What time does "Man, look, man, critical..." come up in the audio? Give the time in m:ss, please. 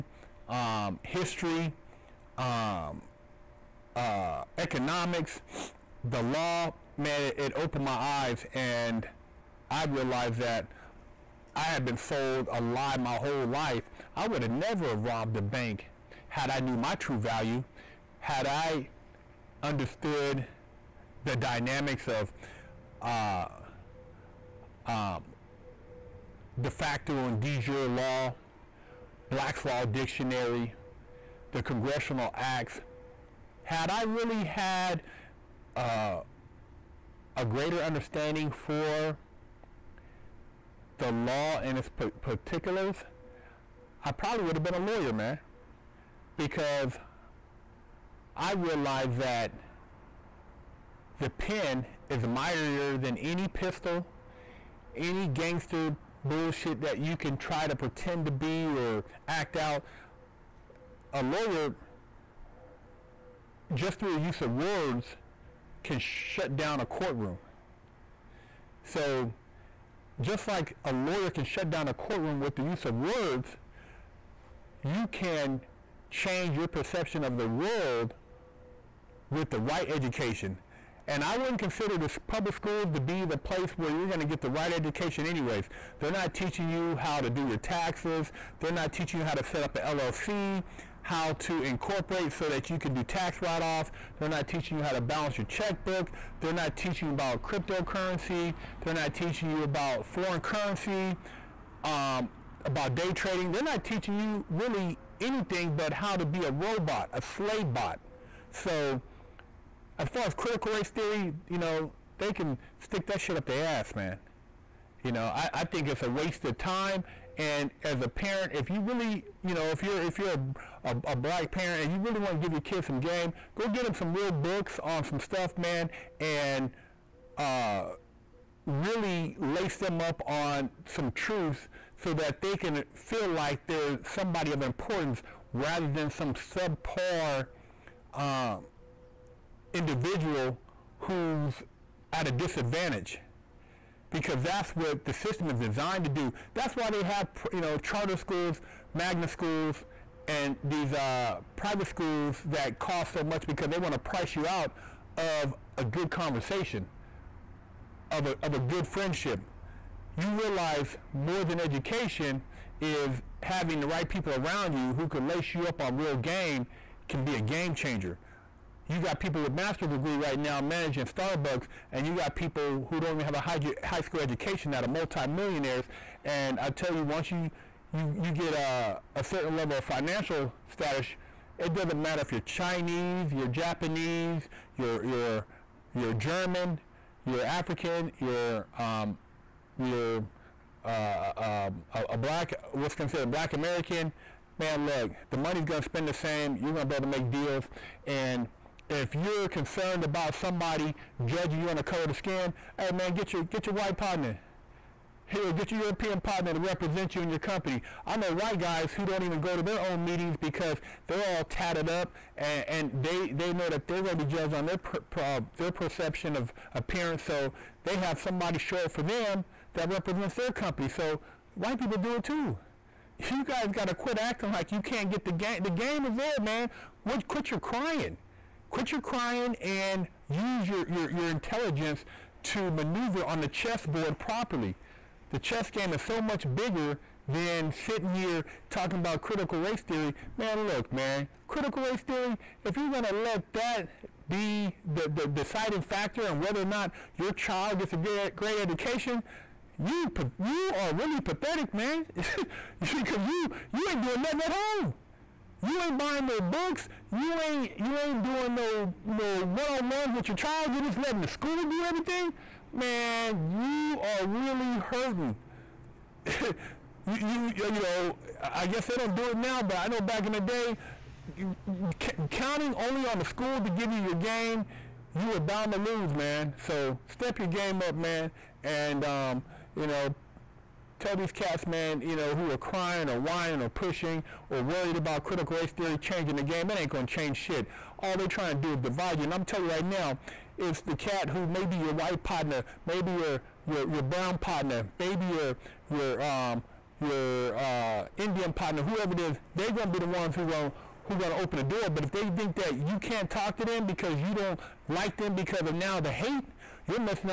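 4:00.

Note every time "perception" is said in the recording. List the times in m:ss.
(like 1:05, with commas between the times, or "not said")
1:16, 3:35.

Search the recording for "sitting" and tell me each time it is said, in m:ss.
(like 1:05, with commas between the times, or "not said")
3:57.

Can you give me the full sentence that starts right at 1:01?
A lawyer, just through the use of words, can shut down a courtroom.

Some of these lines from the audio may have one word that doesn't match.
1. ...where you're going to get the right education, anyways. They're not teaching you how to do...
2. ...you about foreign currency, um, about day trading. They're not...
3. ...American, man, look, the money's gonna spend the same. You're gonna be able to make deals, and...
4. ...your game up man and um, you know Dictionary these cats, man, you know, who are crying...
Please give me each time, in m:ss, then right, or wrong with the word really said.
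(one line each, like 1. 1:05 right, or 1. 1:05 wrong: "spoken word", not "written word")
1. 1:23 right
2. 1:39 right
3. 3:13 right
4. 4:37 wrong: "Tell", not "Dictionary".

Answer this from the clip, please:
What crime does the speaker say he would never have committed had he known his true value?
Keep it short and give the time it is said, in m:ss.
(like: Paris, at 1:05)
Robbed a bank, at 0:14.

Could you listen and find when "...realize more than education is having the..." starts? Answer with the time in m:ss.
2:40.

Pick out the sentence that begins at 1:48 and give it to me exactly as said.
So, as far as critical race theory, you know, they can stick that shit up their ass, man.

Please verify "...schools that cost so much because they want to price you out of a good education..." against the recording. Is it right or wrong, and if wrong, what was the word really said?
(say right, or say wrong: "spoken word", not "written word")
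wrong: "conversation", not "education".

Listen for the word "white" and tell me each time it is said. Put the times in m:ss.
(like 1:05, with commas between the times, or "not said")
3:23, 3:28, 3:41, 4:51.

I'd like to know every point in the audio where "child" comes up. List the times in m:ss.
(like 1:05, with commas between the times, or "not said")
4:07, 4:20.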